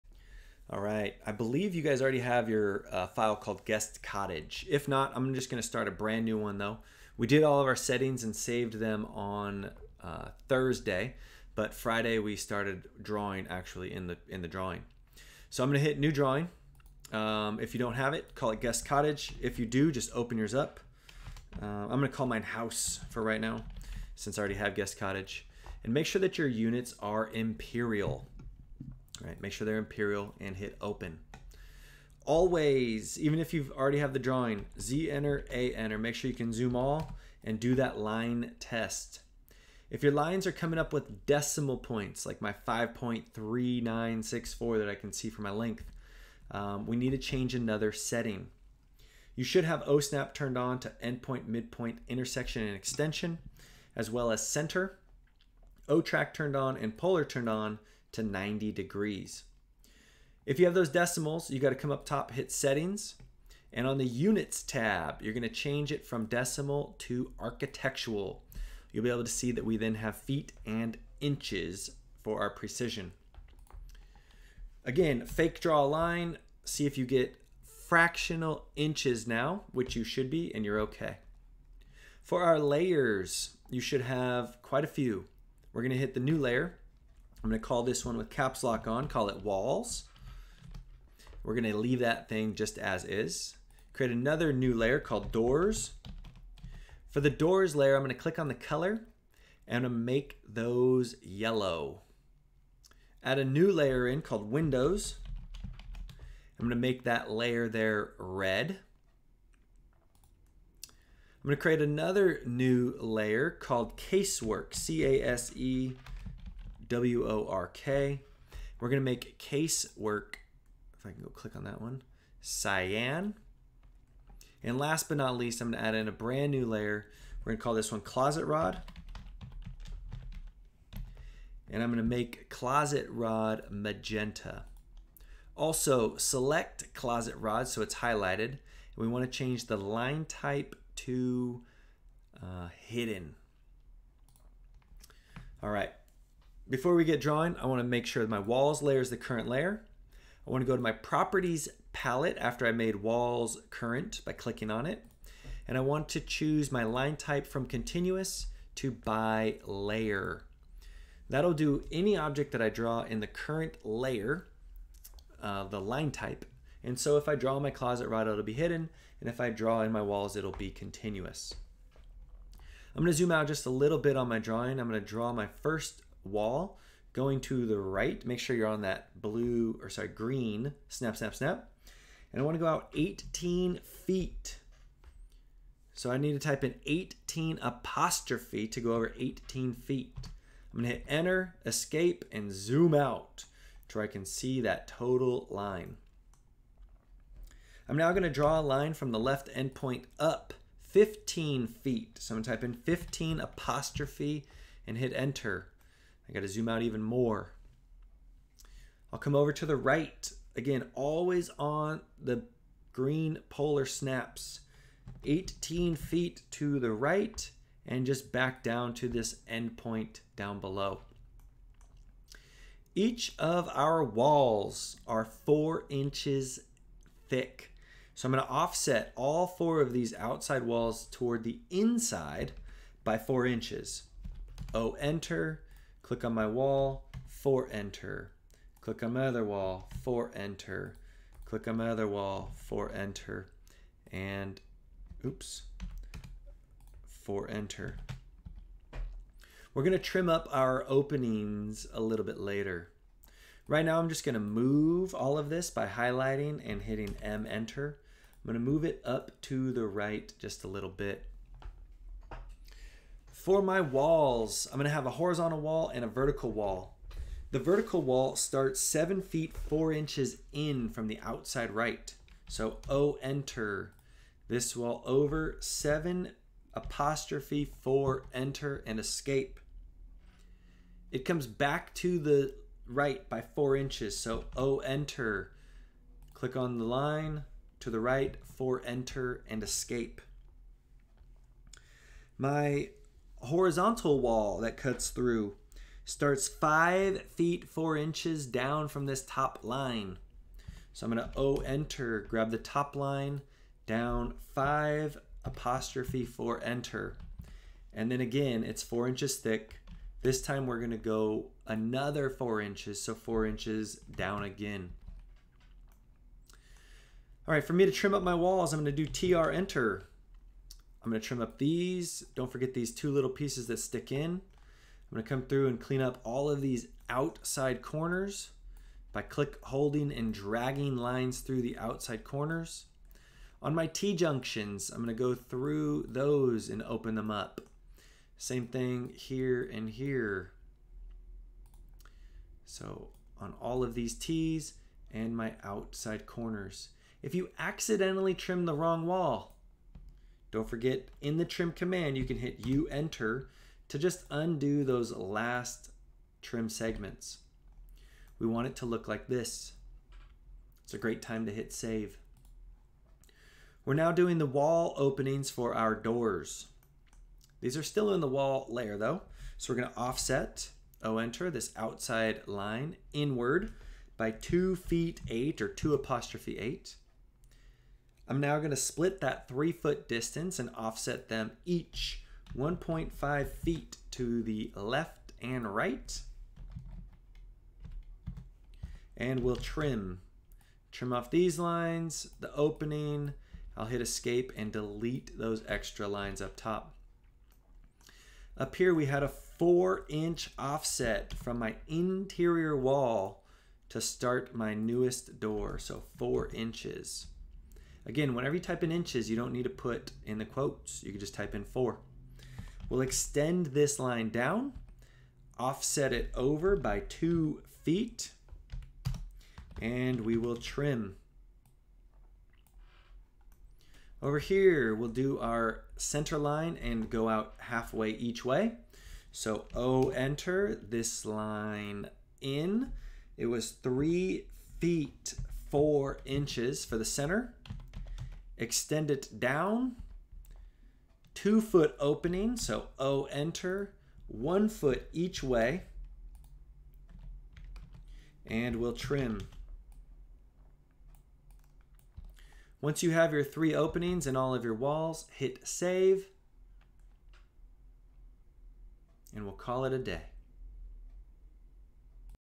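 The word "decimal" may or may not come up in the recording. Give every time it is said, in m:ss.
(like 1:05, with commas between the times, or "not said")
0:41, 1:00, 1:06.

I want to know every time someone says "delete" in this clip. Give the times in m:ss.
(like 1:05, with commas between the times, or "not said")
6:34.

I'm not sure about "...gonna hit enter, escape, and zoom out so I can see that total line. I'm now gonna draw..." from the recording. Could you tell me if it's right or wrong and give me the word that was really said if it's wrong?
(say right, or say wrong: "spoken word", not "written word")
right.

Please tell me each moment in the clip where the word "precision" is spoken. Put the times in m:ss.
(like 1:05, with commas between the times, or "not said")
1:12.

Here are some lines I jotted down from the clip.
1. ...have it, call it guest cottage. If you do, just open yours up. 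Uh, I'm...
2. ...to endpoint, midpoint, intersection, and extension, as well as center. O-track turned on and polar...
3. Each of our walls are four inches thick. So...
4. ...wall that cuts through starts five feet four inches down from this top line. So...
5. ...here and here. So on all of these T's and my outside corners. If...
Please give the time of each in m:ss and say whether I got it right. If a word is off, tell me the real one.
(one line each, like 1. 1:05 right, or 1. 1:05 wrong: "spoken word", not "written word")
1. 0:17 right
2. 0:50 right
3. 3:42 right
4. 4:54 right
5. 5:39 right.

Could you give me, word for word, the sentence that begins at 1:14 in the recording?
Again, fake draw a line, see if you get fractional inches now, which you should be, and you're okay.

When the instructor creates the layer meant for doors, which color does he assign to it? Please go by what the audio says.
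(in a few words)
yellow.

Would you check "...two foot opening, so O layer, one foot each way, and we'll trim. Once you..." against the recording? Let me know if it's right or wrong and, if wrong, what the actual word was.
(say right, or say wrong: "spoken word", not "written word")
wrong: "enter", not "layer".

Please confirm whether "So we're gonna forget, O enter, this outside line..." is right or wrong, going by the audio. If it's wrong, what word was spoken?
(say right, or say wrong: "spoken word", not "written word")
wrong: "offset", not "forget".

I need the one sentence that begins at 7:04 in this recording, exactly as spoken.
Over here, we'll do our center line and go out halfway each way.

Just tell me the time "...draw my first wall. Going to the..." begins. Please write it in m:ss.
2:55.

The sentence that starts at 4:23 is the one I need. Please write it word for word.
For my walls, I'm going to have a horizontal wall and a vertical wall.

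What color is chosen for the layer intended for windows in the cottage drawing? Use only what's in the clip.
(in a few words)
red.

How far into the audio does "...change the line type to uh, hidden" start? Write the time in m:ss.
2:19.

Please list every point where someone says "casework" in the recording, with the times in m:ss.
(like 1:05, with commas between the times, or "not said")
1:53, 1:59.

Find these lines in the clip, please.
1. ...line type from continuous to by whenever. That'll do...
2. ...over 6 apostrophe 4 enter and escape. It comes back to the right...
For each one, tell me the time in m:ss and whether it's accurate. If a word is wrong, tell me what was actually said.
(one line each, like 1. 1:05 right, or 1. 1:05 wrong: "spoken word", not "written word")
1. 2:36 wrong: "layer", not "whenever"
2. 4:35 wrong: "7", not "6".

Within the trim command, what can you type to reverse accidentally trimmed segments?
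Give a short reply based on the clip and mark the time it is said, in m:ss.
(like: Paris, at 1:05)
U enter, at 5:52.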